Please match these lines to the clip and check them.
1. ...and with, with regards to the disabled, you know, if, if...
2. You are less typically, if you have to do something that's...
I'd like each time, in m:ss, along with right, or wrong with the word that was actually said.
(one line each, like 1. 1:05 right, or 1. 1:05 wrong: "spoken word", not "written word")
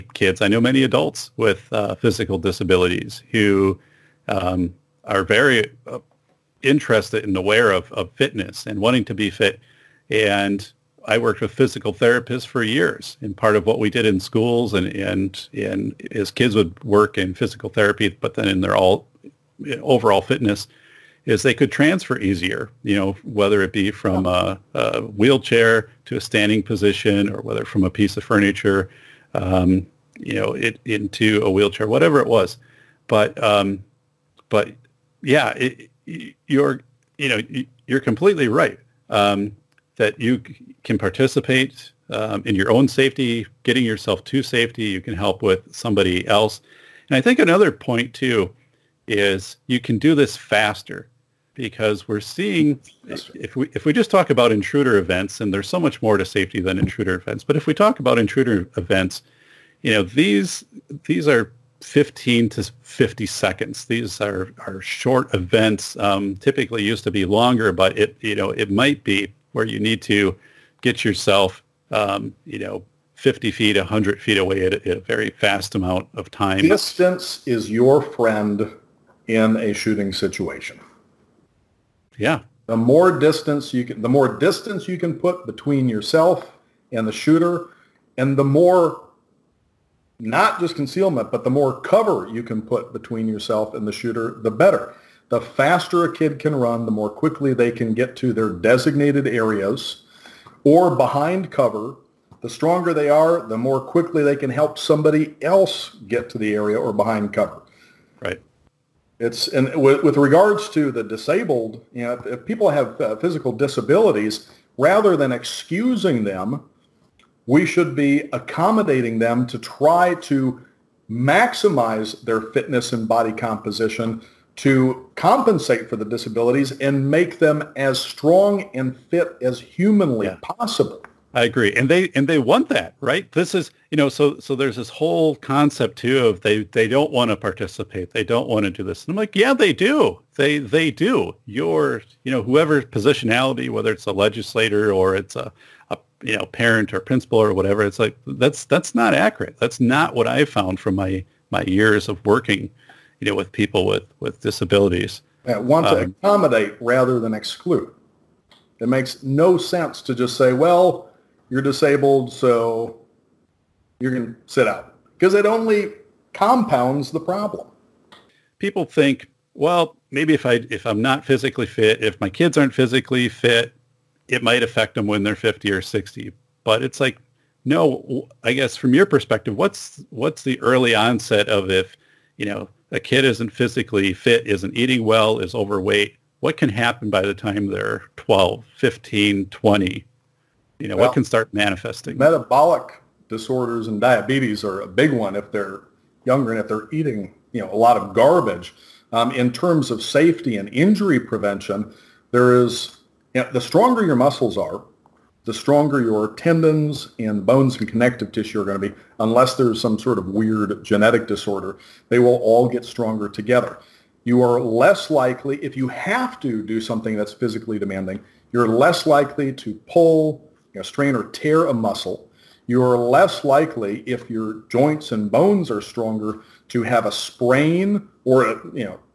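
1. 1:49 right
2. 3:34 wrong: "likely", not "typically".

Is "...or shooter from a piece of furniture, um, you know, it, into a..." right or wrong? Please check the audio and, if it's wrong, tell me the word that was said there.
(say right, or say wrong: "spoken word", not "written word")
wrong: "whether", not "shooter".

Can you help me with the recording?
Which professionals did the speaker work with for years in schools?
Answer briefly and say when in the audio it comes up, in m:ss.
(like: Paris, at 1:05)
Physical therapists, at 0:11.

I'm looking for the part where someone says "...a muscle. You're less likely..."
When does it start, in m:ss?
3:41.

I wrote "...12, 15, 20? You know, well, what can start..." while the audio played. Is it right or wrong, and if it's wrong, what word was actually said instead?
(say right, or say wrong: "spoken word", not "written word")
right.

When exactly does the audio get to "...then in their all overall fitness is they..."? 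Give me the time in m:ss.
0:18.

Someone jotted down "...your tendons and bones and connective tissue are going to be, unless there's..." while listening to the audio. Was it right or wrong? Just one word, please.
right.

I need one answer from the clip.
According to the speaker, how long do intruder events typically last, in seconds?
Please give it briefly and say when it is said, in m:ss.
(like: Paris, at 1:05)
15 to 50 seconds, at 1:01.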